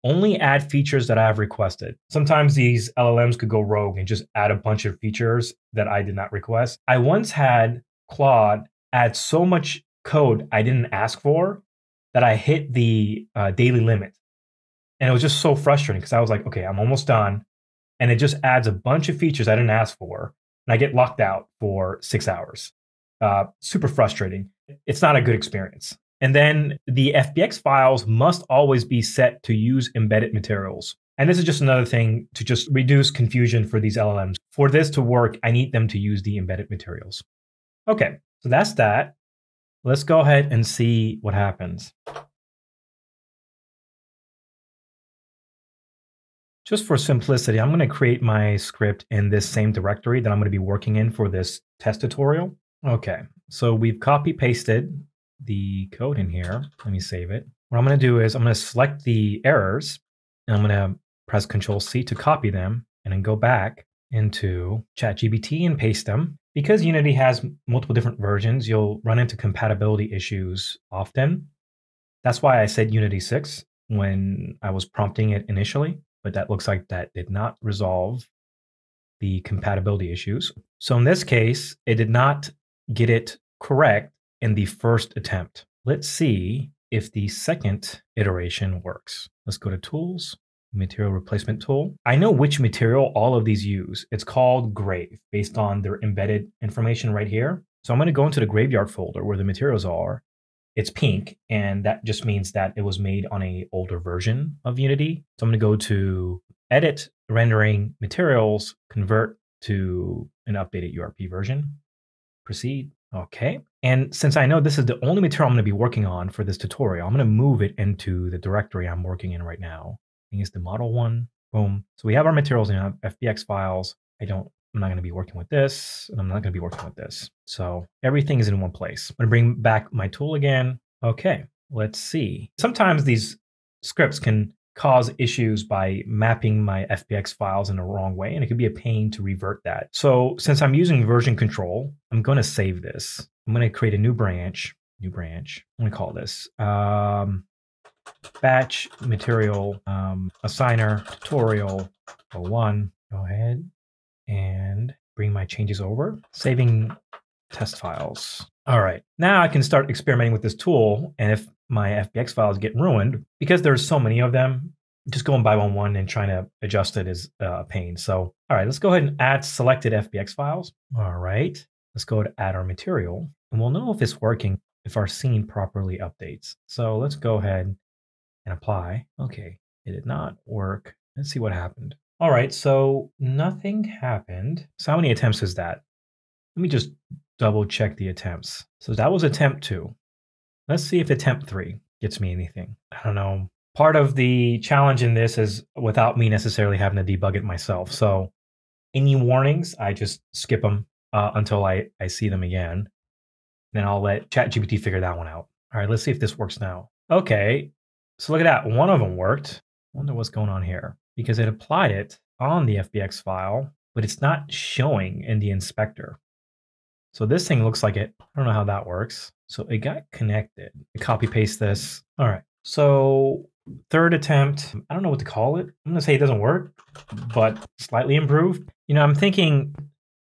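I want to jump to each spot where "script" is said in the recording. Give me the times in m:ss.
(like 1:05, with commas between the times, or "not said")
0:48, 2:13.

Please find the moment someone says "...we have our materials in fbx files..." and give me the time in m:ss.
2:02.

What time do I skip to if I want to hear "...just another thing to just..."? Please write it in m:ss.
0:31.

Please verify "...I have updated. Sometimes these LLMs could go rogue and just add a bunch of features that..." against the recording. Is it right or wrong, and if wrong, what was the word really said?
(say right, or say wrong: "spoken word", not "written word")
wrong: "requested", not "updated".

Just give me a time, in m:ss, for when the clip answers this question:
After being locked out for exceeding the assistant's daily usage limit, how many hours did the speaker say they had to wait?
0:22.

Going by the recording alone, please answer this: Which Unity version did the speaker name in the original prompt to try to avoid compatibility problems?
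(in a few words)
Unity 6.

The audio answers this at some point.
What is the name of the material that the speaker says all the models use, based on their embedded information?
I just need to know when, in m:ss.
1:34.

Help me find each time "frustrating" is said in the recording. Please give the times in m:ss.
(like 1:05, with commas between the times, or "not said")
0:15, 0:23.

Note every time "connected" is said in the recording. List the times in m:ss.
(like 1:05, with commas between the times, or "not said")
3:40.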